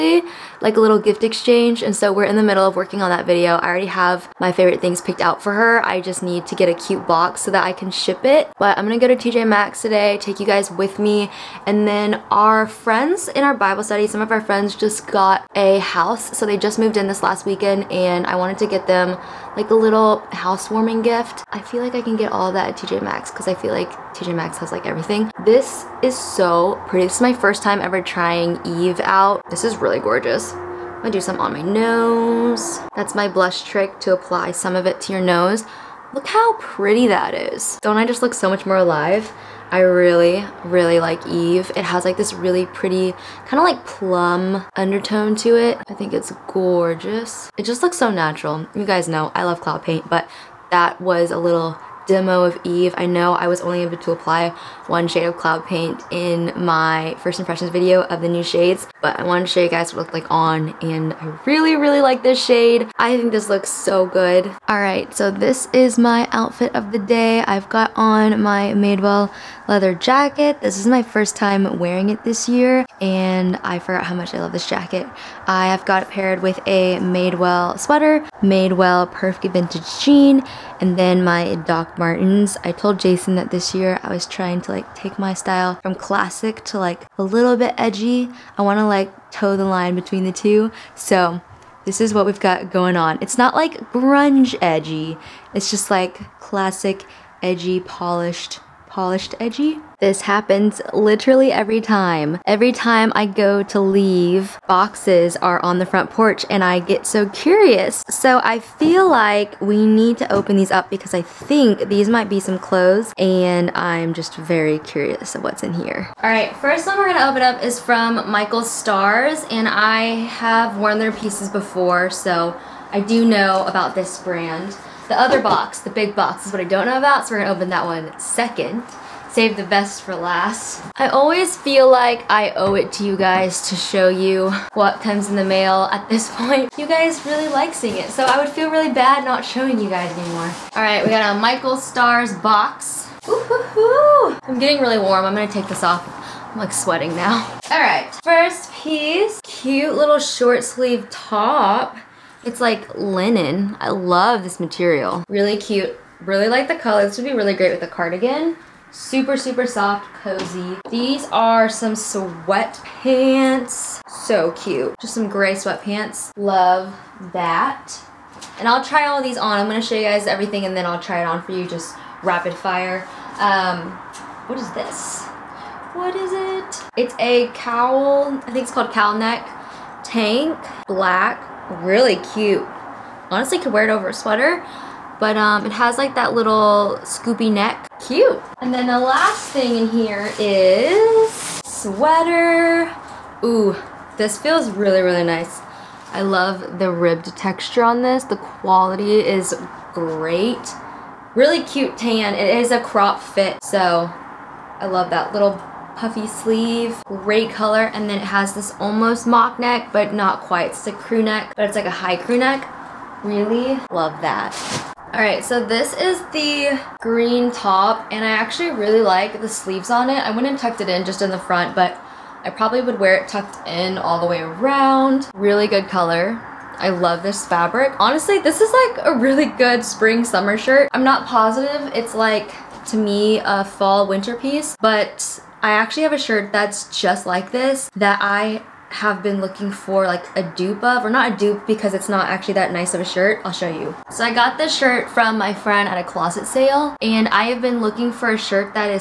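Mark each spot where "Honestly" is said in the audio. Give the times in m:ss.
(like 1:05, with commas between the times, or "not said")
3:03, 3:47.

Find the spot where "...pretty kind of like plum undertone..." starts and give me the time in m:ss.
0:42.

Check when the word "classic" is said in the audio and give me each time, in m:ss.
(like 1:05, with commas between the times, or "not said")
1:25, 1:36.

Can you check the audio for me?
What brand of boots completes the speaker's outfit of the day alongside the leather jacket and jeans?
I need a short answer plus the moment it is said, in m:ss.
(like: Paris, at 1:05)
Doc Martens, at 1:21.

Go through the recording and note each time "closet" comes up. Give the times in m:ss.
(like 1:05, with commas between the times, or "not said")
4:06.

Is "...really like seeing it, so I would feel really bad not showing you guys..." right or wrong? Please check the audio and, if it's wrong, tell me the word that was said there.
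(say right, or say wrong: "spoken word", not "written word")
right.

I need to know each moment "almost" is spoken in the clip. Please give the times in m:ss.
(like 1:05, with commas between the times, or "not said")
3:28.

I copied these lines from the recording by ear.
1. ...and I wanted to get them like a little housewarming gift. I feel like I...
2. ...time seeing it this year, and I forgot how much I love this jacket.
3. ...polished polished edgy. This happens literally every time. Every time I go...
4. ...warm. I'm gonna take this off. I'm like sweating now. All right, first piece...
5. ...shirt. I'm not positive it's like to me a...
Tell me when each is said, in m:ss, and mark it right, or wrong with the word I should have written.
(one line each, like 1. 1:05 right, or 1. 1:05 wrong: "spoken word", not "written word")
1. 0:17 right
2. 1:11 wrong: "wearing", not "seeing"
3. 1:37 right
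4. 2:25 right
5. 3:50 right.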